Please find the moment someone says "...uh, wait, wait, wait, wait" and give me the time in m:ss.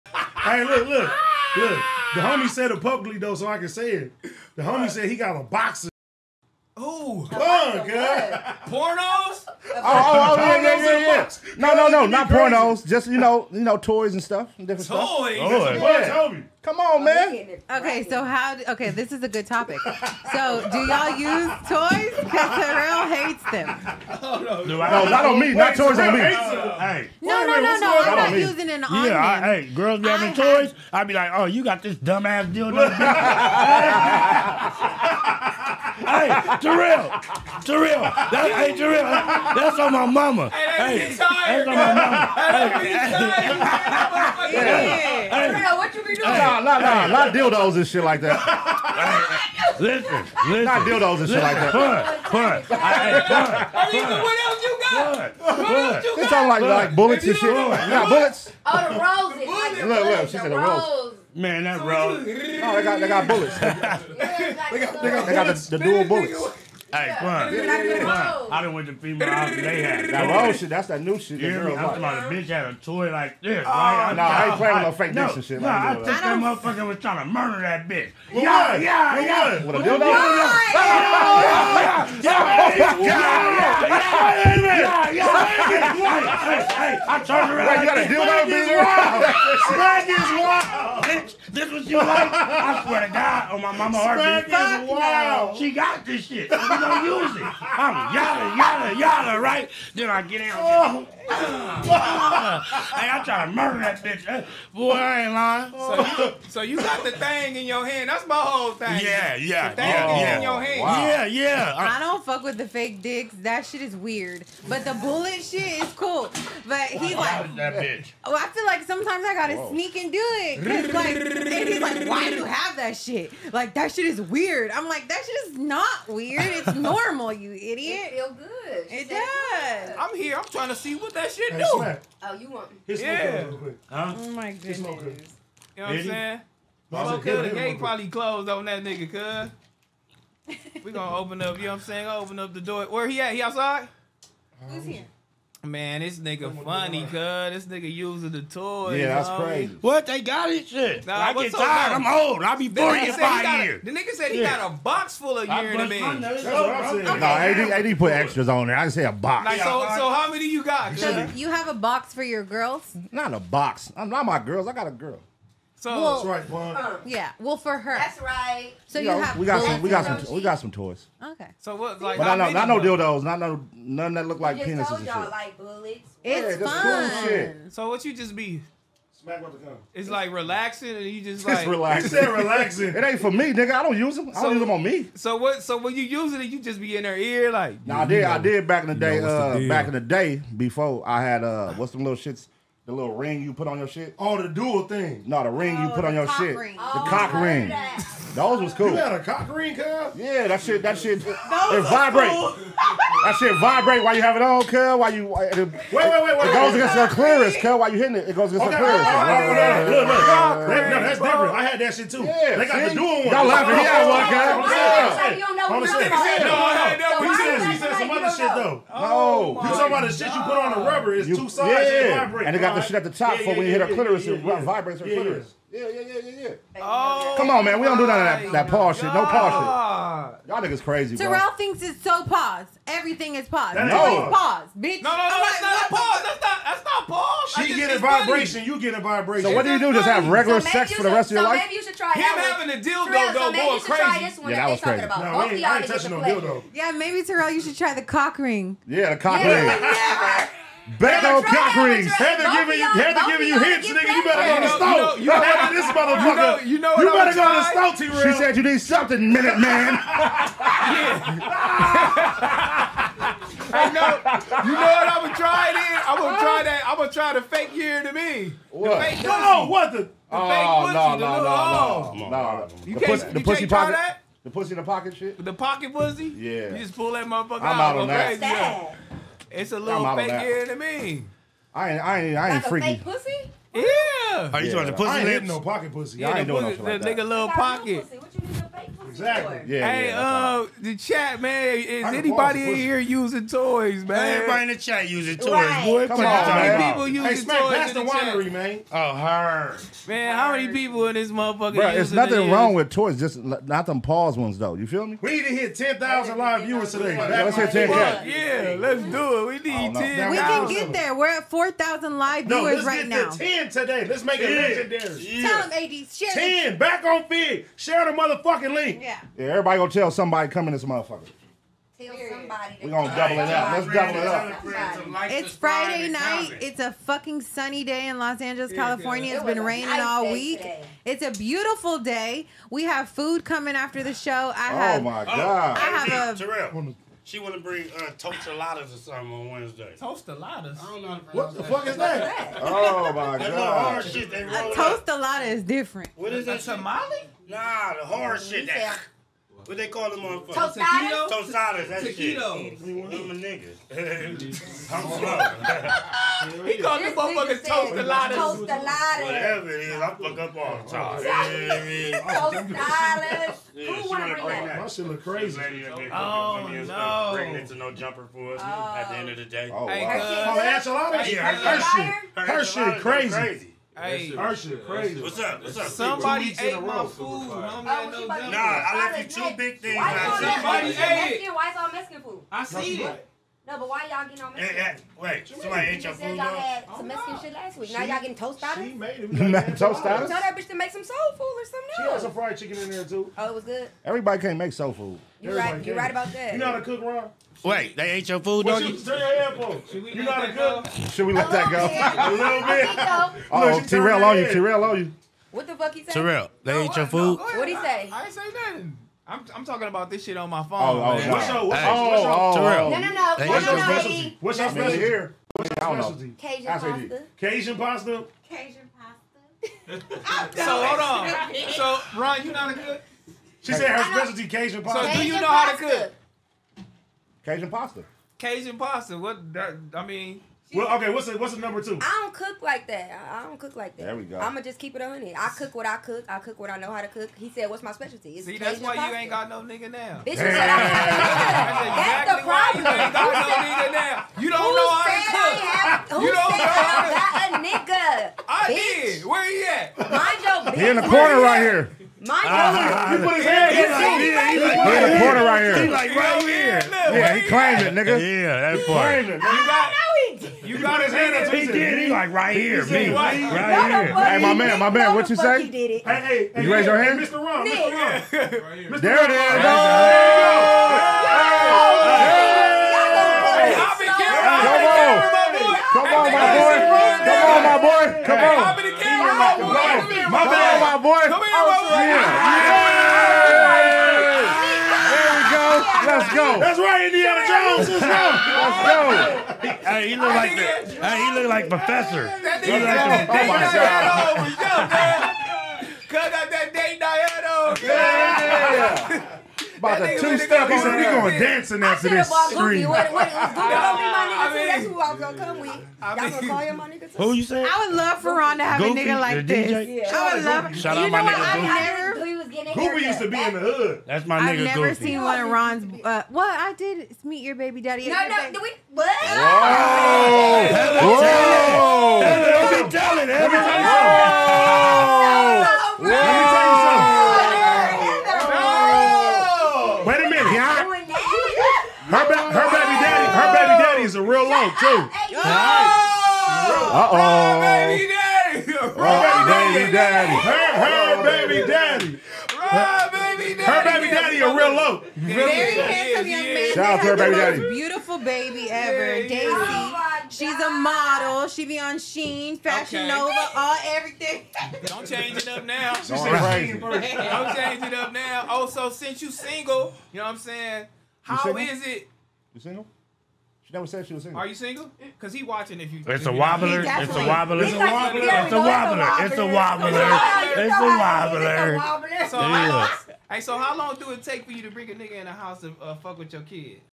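3:25.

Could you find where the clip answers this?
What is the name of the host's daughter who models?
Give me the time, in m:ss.
9:09.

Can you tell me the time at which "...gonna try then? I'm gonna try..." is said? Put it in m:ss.
4:25.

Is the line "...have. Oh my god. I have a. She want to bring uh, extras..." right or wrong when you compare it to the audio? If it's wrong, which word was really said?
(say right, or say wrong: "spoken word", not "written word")
wrong: "toastaladas", not "extras".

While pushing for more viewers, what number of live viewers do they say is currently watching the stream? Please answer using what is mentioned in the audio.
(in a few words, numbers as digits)
4,000.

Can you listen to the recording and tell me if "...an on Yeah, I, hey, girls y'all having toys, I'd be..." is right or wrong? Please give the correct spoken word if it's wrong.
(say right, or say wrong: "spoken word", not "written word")
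right.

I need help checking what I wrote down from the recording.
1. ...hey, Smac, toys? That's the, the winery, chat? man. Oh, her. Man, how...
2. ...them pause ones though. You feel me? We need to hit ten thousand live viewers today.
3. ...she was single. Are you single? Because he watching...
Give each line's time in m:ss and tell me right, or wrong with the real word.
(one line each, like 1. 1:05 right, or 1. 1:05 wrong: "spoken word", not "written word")
1. 4:57 right
2. 5:03 right
3. 9:24 right.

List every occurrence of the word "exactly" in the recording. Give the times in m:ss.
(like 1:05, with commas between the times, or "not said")
4:49, 7:22.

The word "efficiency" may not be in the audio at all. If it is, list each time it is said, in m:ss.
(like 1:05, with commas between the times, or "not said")
not said.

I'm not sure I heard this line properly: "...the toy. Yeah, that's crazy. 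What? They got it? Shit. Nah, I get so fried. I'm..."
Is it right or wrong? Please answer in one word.
wrong.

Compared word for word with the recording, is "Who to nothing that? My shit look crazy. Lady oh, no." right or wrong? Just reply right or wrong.
wrong.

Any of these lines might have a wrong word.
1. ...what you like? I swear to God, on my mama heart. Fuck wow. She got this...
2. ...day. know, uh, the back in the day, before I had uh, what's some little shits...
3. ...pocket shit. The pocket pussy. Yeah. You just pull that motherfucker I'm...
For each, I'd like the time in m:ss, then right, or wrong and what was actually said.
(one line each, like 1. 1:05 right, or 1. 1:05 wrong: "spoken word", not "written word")
1. 1:31 right
2. 3:08 right
3. 4:34 right.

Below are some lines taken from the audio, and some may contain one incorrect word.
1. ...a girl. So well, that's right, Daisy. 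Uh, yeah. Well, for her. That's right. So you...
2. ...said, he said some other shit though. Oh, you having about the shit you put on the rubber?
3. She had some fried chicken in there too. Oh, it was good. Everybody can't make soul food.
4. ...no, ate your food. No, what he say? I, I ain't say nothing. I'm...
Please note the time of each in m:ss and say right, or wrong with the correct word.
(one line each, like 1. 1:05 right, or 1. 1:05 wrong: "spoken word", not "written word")
1. 2:44 wrong: "Bun", not "Daisy"
2. 3:37 wrong: "talking", not "having"
3. 6:31 right
4. 6:46 right.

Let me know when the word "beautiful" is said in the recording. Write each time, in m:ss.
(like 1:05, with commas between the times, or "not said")
5:31, 9:07.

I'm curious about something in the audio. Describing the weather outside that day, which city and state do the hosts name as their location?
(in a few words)
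Los Angeles, California.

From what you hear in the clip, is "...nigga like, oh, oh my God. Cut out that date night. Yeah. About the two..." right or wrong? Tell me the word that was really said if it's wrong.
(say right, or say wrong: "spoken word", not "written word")
right.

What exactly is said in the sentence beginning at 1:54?
But the bullet shit is cool.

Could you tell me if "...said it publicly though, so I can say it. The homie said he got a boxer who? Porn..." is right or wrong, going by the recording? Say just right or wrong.
right.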